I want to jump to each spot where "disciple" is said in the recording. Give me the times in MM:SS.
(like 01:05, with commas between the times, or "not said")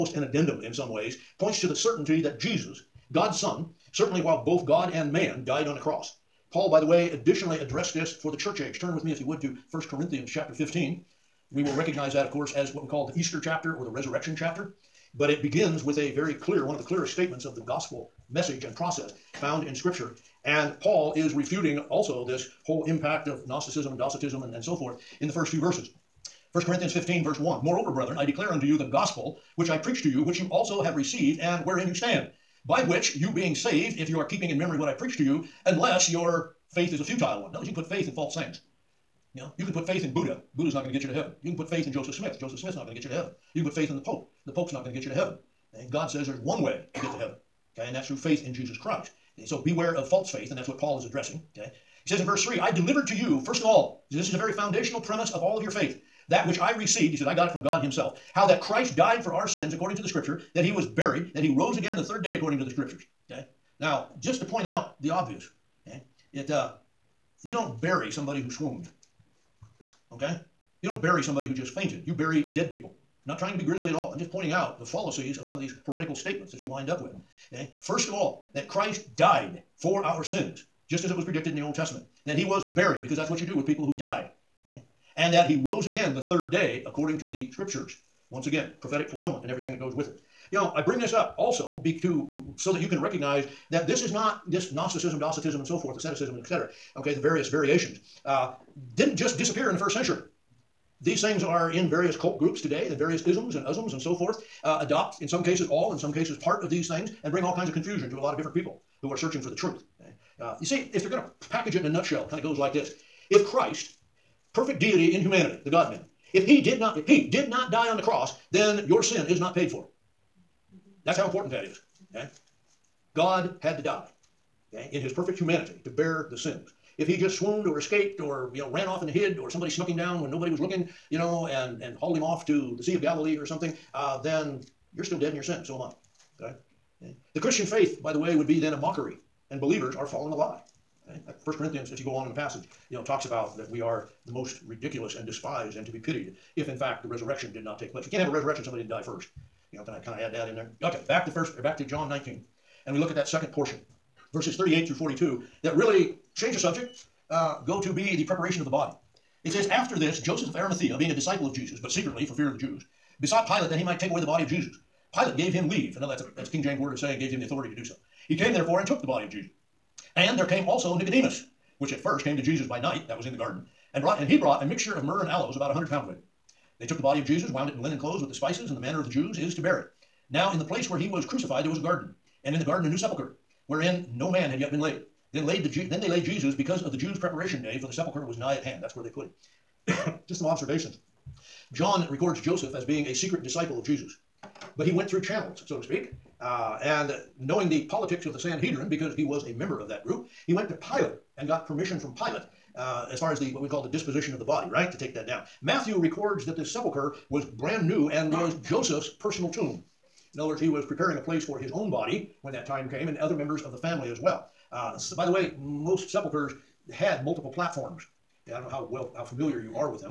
02:41, 03:13.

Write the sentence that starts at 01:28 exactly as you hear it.
Once again, prophetic fulfillment and everything that goes with it.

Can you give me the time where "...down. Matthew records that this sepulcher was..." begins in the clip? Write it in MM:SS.
03:25.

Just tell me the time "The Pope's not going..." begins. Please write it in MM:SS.
00:44.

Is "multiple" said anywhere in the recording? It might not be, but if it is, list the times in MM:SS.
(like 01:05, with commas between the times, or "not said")
03:37.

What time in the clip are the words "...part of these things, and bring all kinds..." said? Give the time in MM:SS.
01:46.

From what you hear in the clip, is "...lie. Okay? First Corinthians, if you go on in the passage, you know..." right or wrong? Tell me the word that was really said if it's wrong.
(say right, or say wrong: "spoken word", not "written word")
right.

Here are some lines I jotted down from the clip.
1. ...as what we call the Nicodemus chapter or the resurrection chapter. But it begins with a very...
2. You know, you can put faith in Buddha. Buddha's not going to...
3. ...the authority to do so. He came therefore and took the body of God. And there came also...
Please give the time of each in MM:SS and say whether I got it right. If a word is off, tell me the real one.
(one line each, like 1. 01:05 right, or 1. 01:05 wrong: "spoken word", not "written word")
1. 00:12 wrong: "Easter", not "Nicodemus"
2. 00:39 right
3. 02:47 wrong: "Jesus", not "God".